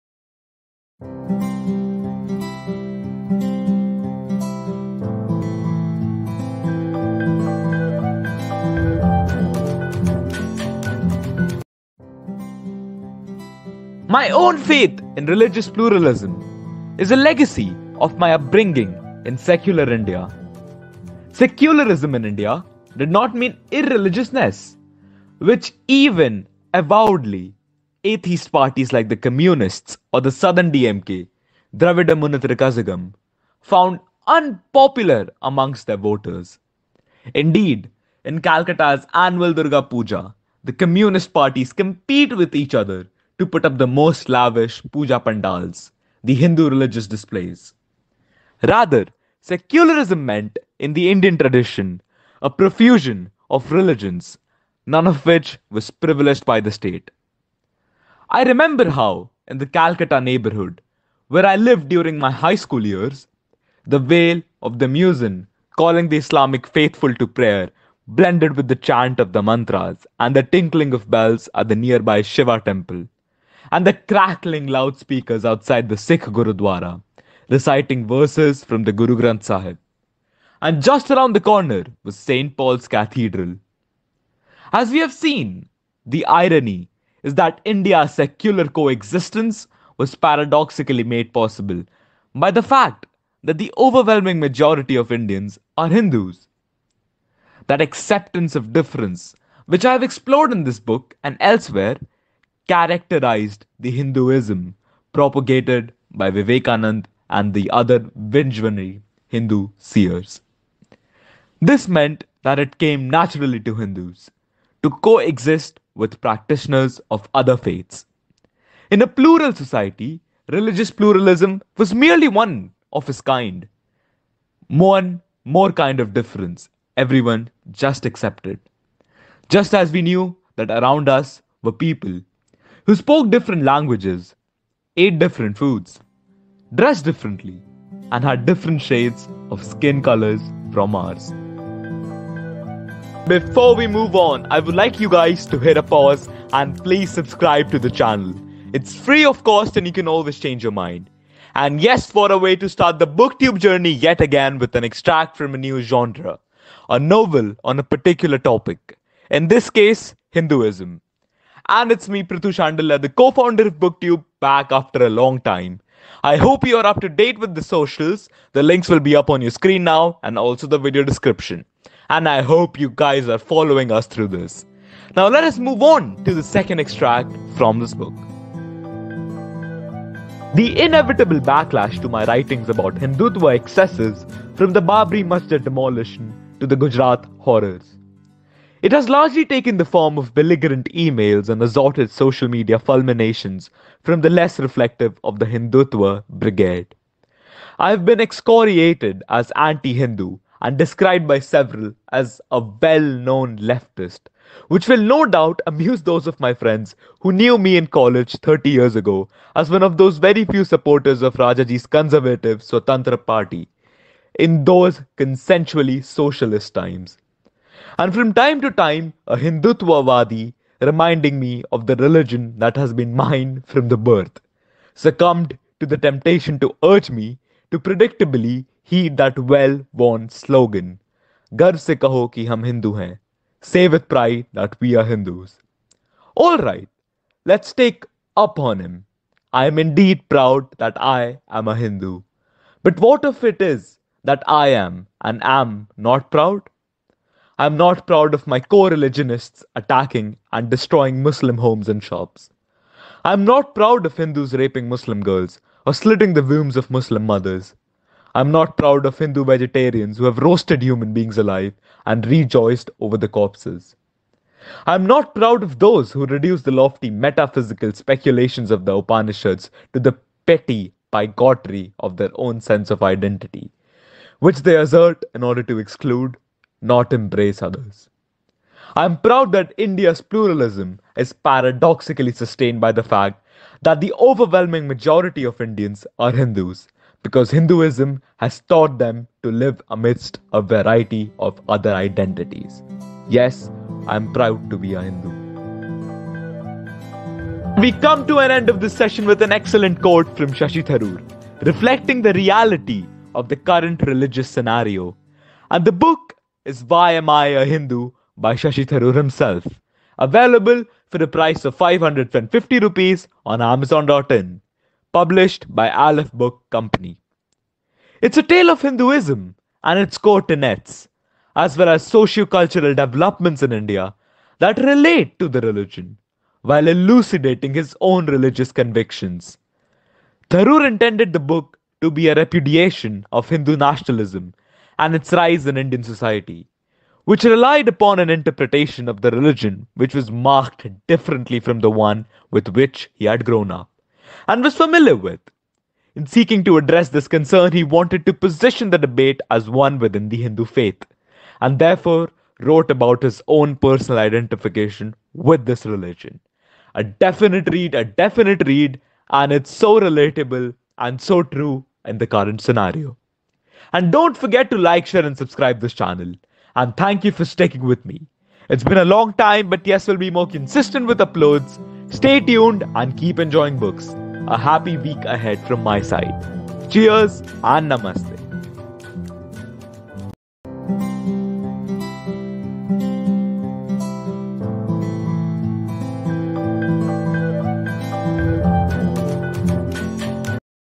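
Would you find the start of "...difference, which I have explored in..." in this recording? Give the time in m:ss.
1:38.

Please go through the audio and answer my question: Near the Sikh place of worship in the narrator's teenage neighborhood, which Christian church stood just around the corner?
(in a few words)
St. Paul's Cathedral.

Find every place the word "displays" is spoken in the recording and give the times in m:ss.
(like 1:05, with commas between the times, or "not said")
0:47.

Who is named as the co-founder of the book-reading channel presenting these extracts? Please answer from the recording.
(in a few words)
Prithu Shandilya.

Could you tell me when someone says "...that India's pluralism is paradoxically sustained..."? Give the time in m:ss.
4:39.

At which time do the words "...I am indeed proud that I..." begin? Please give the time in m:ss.
3:59.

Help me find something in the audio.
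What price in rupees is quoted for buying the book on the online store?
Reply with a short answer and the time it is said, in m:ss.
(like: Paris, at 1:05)
550 rupees, at 5:11.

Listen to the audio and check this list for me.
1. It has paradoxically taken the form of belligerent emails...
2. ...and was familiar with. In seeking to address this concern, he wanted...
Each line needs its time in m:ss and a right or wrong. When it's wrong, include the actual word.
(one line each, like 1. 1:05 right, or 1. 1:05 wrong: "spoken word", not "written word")
1. 3:08 wrong: "largely", not "paradoxically"
2. 5:44 right.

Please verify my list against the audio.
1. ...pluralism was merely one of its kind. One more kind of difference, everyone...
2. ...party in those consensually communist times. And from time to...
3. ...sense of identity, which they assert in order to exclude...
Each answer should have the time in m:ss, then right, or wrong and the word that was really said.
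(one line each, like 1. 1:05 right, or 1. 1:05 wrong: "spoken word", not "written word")
1. 2:00 right
2. 3:33 wrong: "socialist", not "communist"
3. 4:32 right.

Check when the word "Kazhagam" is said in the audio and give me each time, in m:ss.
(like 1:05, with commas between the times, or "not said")
0:32.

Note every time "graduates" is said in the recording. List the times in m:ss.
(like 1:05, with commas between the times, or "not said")
not said.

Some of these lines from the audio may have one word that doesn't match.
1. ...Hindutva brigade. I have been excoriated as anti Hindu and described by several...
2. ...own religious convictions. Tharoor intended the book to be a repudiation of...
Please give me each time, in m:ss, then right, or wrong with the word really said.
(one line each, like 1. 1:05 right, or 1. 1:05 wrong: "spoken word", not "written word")
1. 3:15 right
2. 5:27 right.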